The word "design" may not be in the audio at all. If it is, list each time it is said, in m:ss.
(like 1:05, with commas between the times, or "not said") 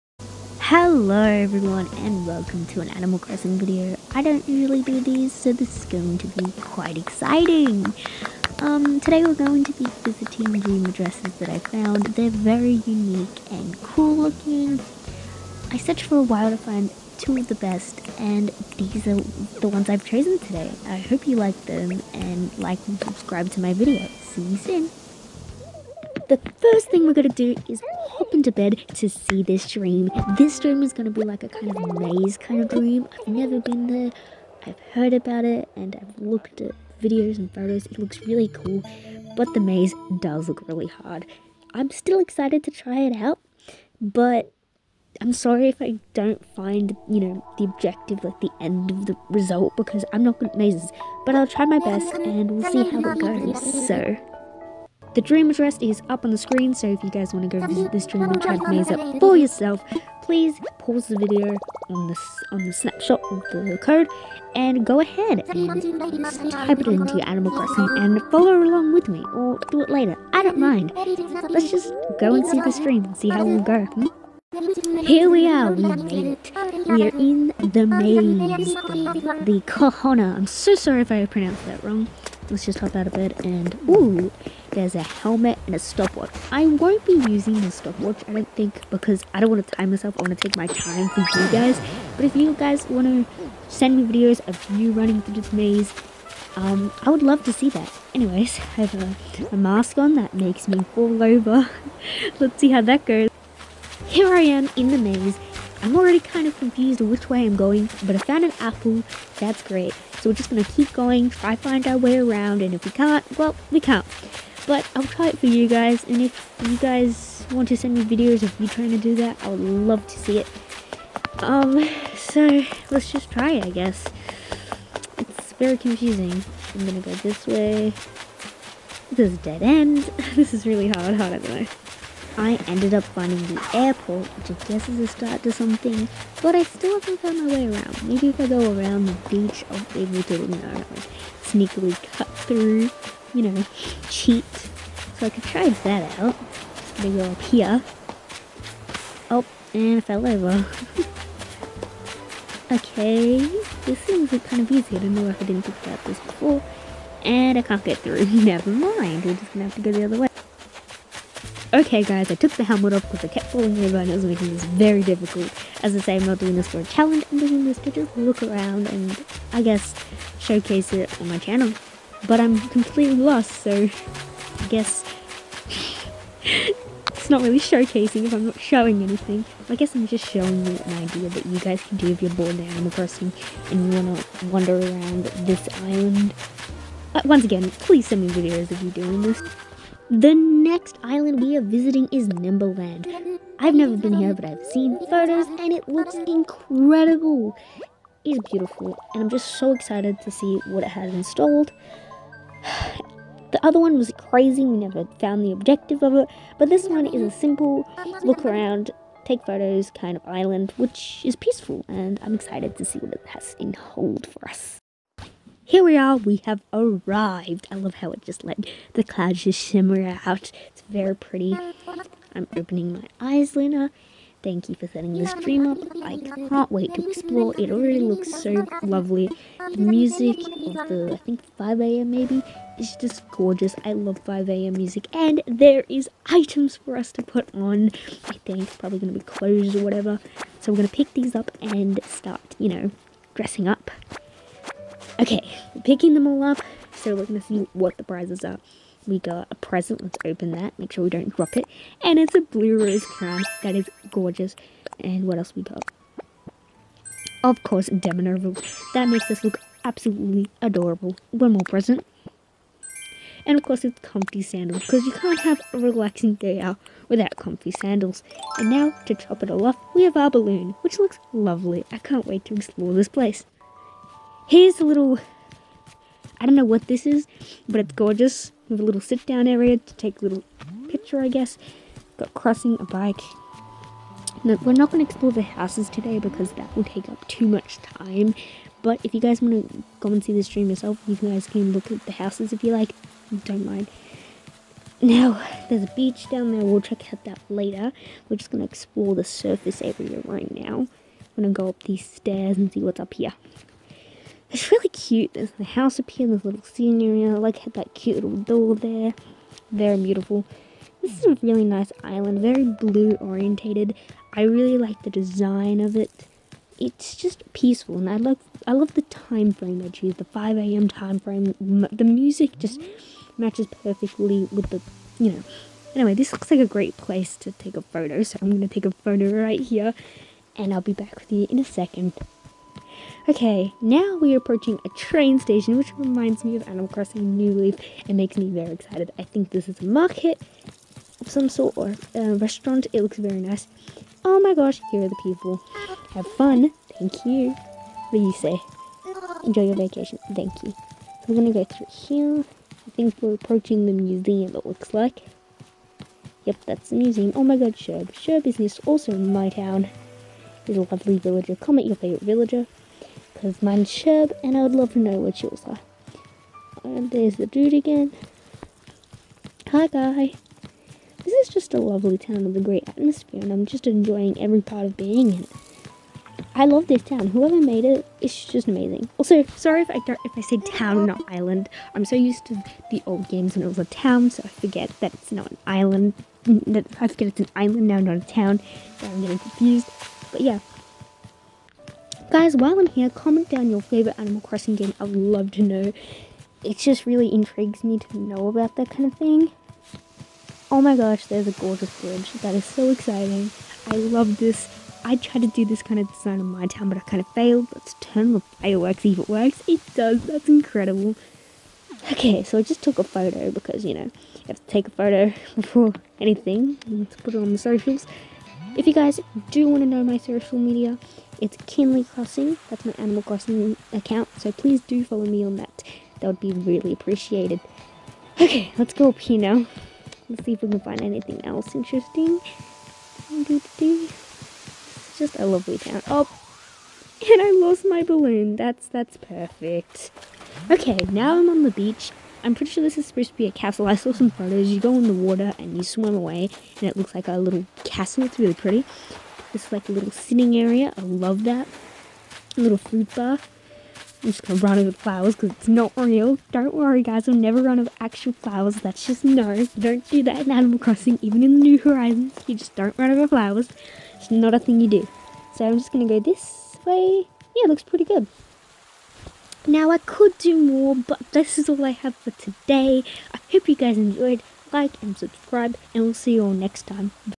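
5:15, 6:46.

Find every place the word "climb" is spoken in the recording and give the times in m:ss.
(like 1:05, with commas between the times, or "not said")
not said.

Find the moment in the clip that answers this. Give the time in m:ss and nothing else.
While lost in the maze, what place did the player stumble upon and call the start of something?
2:13.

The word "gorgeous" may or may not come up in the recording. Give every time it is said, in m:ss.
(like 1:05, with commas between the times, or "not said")
3:53, 4:14, 4:37, 6:41.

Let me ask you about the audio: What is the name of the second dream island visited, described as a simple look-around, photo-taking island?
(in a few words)
Nimberland.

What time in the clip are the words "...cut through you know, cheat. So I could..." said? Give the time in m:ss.
2:22.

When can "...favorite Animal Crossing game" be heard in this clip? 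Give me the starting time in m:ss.
6:33.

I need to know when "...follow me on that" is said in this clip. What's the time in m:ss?
7:05.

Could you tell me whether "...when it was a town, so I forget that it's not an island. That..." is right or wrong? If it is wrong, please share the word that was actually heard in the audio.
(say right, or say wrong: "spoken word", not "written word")
right.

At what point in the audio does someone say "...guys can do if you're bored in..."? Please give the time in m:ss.
3:01.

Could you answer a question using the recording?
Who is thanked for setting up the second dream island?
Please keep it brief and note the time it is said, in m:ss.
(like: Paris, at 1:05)
Lena, at 3:43.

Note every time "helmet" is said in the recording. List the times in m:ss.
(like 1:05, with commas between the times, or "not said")
1:25, 2:42.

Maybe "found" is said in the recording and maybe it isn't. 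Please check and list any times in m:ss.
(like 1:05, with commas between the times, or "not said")
0:11, 1:48, 2:17, 3:25.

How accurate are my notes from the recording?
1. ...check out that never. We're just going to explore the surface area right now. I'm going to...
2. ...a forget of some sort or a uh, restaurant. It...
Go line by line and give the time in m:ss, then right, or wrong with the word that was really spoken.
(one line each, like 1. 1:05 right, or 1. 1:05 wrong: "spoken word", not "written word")
1. 4:56 wrong: "later", not "never"
2. 5:39 wrong: "market", not "forget".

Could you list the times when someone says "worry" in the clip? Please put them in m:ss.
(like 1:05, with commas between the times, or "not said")
7:36.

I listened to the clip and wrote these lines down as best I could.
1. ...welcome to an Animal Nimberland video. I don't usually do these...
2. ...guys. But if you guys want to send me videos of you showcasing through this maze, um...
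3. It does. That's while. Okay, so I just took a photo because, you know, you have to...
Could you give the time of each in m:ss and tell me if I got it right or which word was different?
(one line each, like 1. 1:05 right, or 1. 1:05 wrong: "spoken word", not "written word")
1. 0:02 wrong: "Crossing", not "Nimberland"
2. 1:31 wrong: "running", not "showcasing"
3. 6:49 wrong: "incredible", not "while".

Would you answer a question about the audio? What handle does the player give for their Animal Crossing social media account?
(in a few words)
Kinley Crossing.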